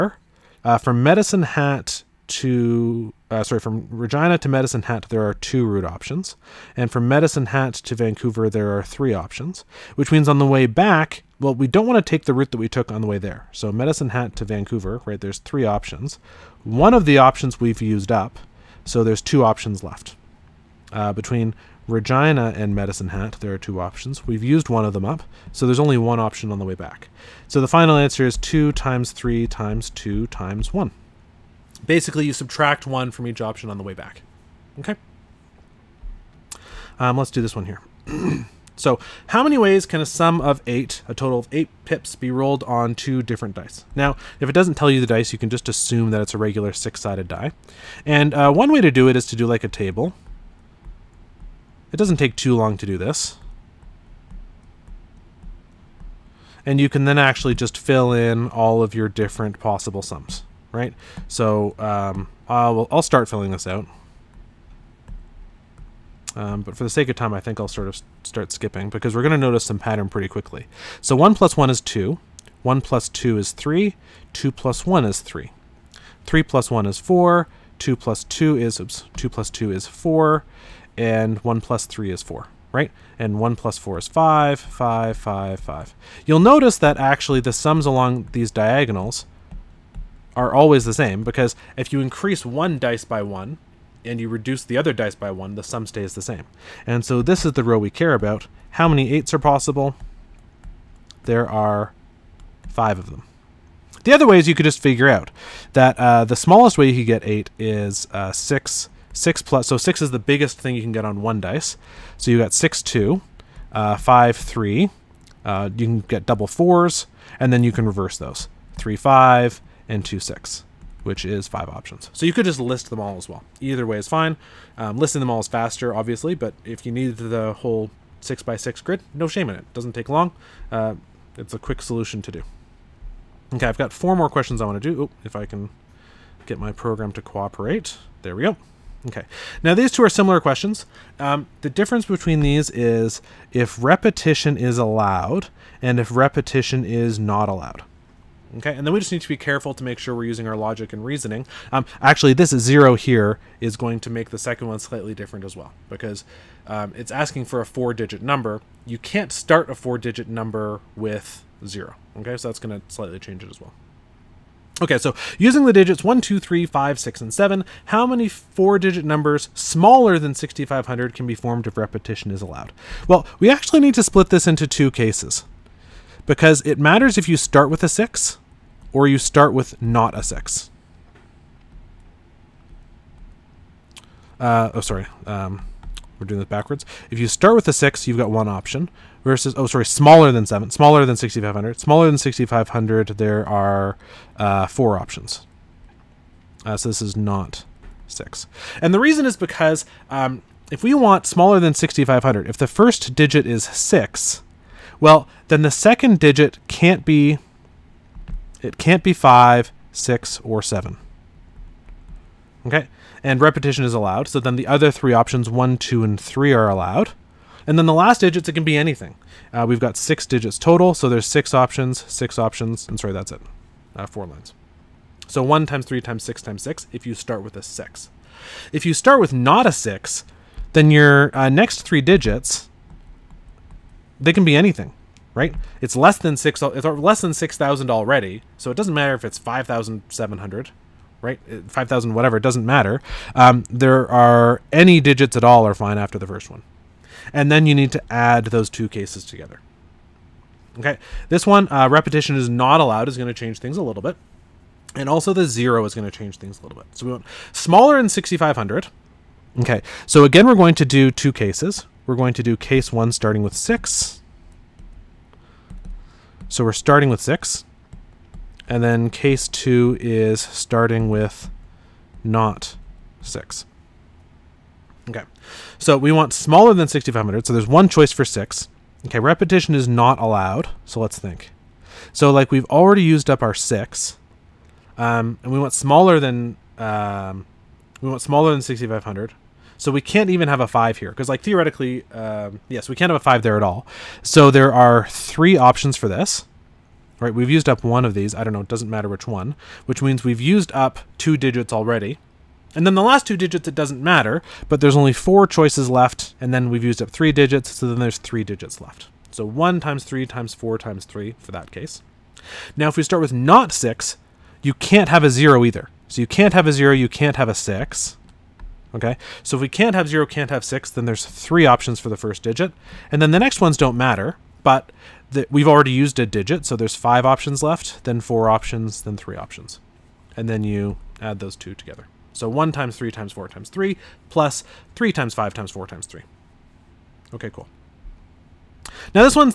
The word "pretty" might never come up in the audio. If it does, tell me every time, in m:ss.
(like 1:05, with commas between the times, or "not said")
1:10.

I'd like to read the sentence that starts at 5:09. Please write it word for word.
So one times three times four times three for that case.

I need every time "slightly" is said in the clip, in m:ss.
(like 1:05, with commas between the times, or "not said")
2:34, 2:42.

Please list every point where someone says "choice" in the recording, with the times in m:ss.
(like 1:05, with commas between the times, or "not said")
4:37, 5:05.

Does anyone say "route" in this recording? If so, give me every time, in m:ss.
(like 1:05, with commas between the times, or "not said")
0:05, 0:12.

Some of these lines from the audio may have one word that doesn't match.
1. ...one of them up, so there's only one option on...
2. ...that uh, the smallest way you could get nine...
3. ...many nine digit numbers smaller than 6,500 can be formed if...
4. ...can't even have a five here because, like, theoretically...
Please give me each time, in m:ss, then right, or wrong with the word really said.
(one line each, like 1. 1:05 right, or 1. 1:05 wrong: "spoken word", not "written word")
1. 0:24 right
2. 1:45 wrong: "eight", not "nine"
3. 2:48 wrong: "four", not "nine"
4. 4:49 right.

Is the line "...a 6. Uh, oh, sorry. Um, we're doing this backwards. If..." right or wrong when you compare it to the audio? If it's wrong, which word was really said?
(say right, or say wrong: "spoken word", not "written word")
right.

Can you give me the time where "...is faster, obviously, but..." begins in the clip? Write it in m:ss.
2:05.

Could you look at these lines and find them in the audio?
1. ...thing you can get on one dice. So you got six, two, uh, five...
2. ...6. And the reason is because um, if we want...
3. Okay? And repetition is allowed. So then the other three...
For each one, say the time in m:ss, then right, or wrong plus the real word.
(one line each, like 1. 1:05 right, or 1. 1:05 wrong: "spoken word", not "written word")
1. 1:50 right
2. 3:18 right
3. 3:32 right.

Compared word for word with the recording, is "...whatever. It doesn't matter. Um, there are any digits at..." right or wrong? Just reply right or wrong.
right.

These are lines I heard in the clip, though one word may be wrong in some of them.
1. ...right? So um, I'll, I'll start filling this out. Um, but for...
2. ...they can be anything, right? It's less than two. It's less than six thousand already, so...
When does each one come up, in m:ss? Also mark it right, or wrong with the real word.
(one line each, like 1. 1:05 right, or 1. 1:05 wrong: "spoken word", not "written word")
1. 1:00 right
2. 3:54 wrong: "six", not "two".